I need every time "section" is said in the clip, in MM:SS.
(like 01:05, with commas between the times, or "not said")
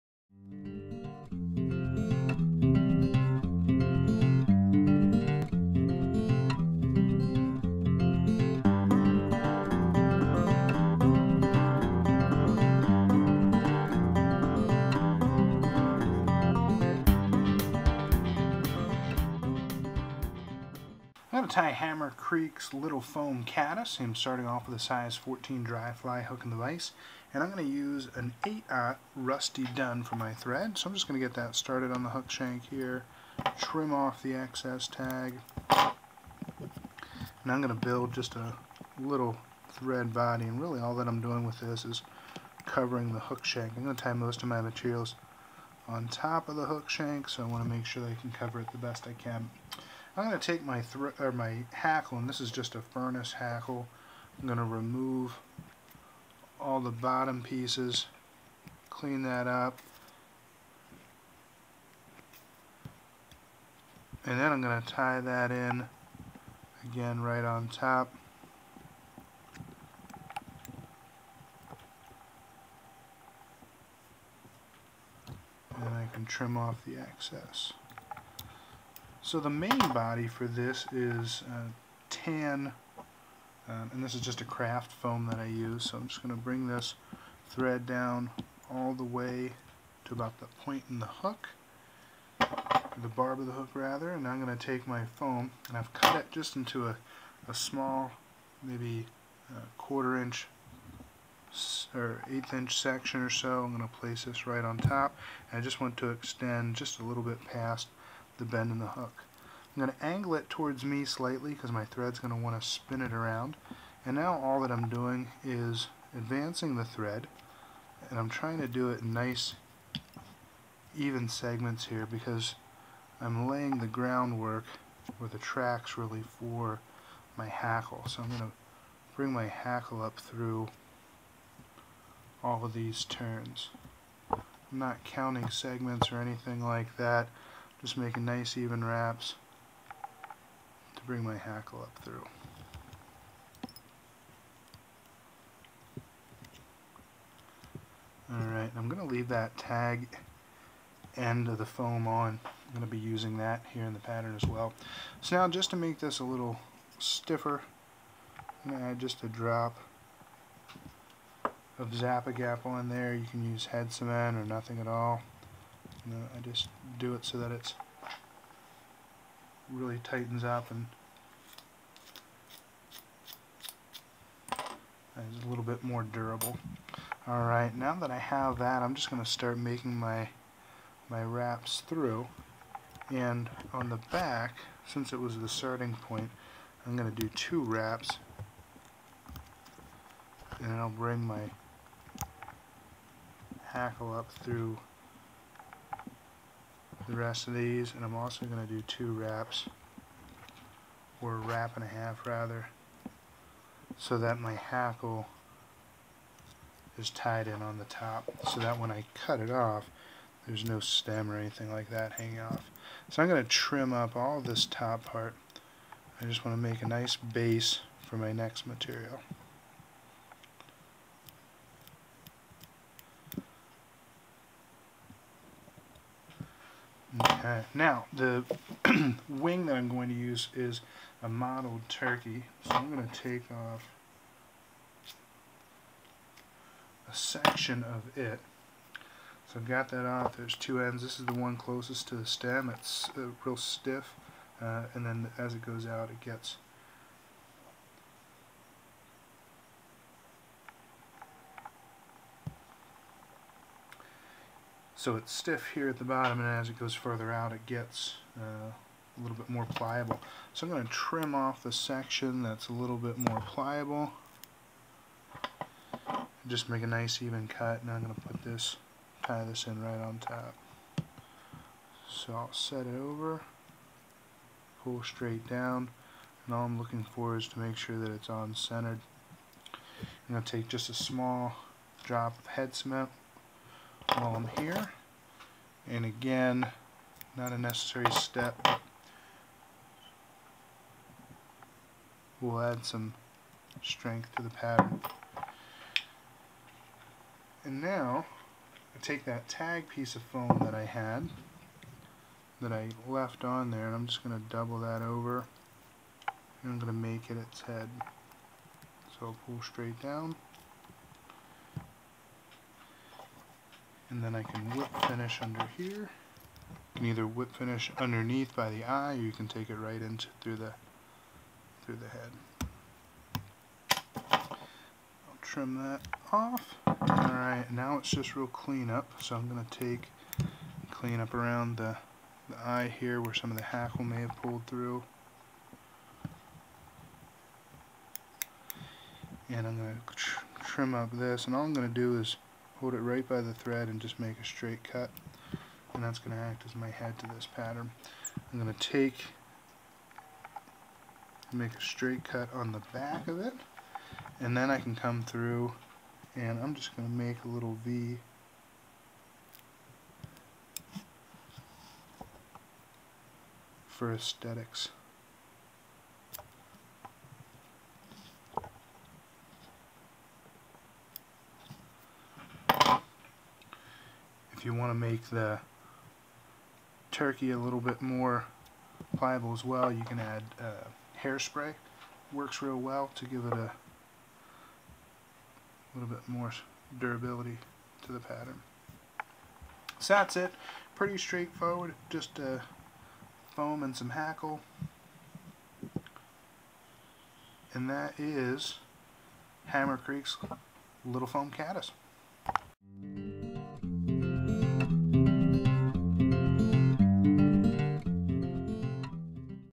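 01:42, 03:57, 04:21.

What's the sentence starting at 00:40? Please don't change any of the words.
And really all that I'm doing with this is covering the hook shank.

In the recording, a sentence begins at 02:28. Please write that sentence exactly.
Alright, I'm going to leave that tag end of the foam on.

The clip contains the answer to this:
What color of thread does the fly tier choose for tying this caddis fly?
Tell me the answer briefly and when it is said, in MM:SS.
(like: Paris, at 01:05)
Rusty dun, at 00:29.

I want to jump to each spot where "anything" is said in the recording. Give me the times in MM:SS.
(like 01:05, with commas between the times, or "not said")
02:16, 03:31.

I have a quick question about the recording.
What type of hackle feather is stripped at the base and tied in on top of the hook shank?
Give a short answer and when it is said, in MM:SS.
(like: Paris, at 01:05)
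Furnace hackle, at 00:52.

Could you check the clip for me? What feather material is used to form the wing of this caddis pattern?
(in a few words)
Mottled turkey.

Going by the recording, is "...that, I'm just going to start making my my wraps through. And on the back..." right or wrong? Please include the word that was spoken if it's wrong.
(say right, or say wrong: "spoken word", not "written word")
right.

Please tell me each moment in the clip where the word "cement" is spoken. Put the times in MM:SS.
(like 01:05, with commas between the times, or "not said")
02:43, 04:42.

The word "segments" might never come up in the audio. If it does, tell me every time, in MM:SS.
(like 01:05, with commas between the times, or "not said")
02:01, 02:15.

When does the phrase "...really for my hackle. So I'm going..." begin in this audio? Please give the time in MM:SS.
02:05.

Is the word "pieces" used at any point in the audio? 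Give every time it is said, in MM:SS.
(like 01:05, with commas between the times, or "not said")
00:57, 04:59.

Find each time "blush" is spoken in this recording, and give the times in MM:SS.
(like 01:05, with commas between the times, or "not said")
not said.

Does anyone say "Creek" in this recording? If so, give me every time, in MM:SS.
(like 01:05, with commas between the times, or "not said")
00:22, 06:39.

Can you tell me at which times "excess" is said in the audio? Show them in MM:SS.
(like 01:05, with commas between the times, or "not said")
00:34, 01:16.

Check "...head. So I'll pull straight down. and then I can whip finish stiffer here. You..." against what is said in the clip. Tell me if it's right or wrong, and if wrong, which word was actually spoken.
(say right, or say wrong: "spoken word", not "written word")
wrong: "under", not "stiffer".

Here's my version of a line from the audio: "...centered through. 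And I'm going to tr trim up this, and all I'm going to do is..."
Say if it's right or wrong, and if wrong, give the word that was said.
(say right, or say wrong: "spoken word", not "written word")
wrong: "pulled", not "centered".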